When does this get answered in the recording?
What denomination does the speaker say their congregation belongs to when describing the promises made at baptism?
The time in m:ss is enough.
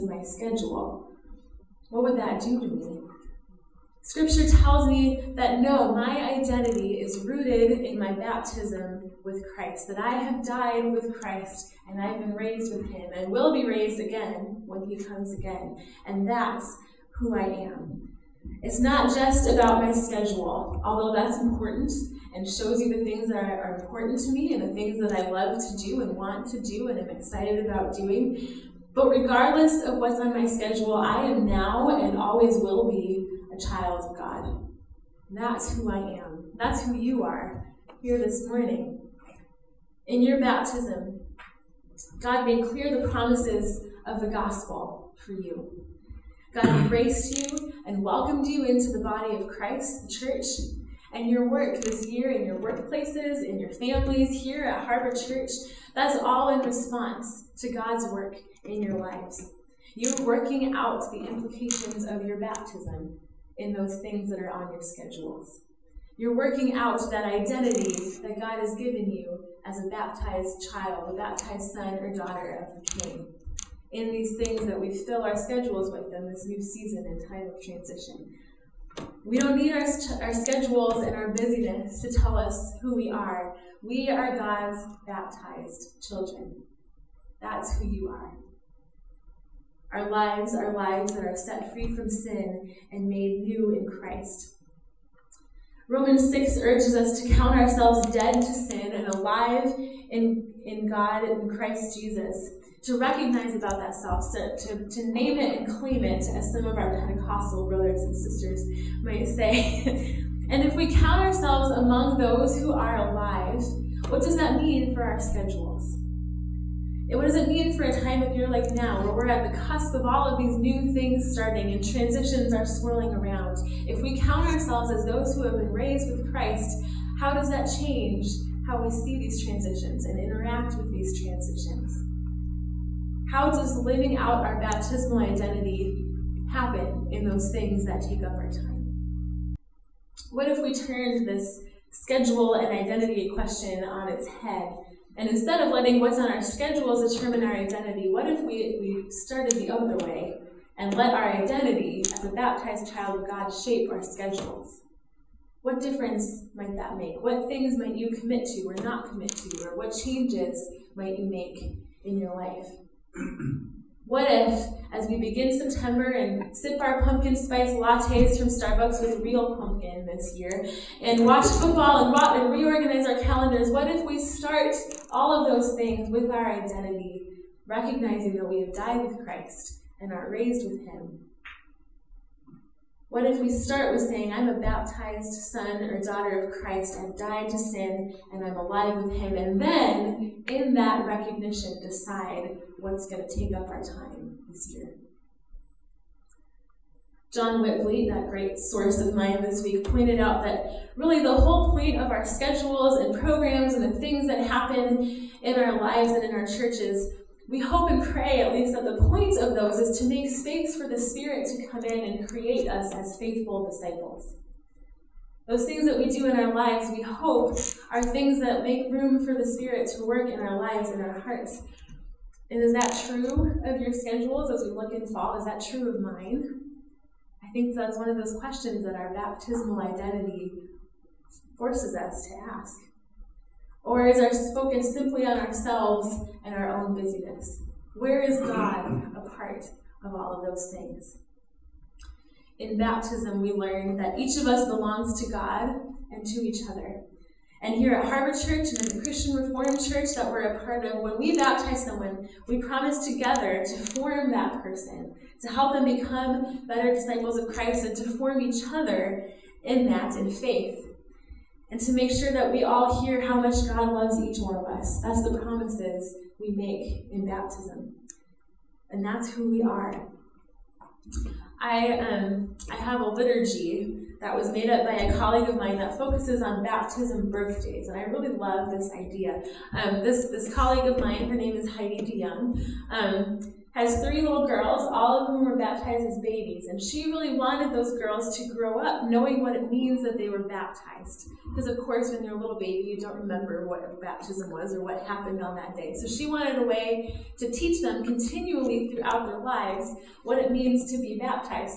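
4:09.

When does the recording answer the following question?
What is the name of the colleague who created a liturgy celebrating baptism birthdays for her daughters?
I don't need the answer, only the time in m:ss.
4:41.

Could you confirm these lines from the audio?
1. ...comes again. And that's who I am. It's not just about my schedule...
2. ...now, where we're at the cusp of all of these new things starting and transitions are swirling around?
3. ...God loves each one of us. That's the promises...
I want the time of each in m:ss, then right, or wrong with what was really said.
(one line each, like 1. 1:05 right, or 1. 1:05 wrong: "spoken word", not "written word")
1. 0:14 right
2. 1:58 right
3. 4:23 right.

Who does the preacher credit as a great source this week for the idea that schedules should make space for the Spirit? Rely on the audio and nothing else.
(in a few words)
John Witvliet.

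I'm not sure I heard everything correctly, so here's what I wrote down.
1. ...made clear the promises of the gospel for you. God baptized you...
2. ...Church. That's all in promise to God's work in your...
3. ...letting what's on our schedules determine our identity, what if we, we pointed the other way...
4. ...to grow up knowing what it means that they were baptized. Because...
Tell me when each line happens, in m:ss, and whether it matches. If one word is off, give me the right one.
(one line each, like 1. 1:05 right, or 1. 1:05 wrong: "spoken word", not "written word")
1. 0:42 wrong: "embraced", not "baptized"
2. 0:55 wrong: "response", not "promise"
3. 2:25 wrong: "started", not "pointed"
4. 4:48 right.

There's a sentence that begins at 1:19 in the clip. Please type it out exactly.
We don't need our, our schedules and our busyness to tell us who we are.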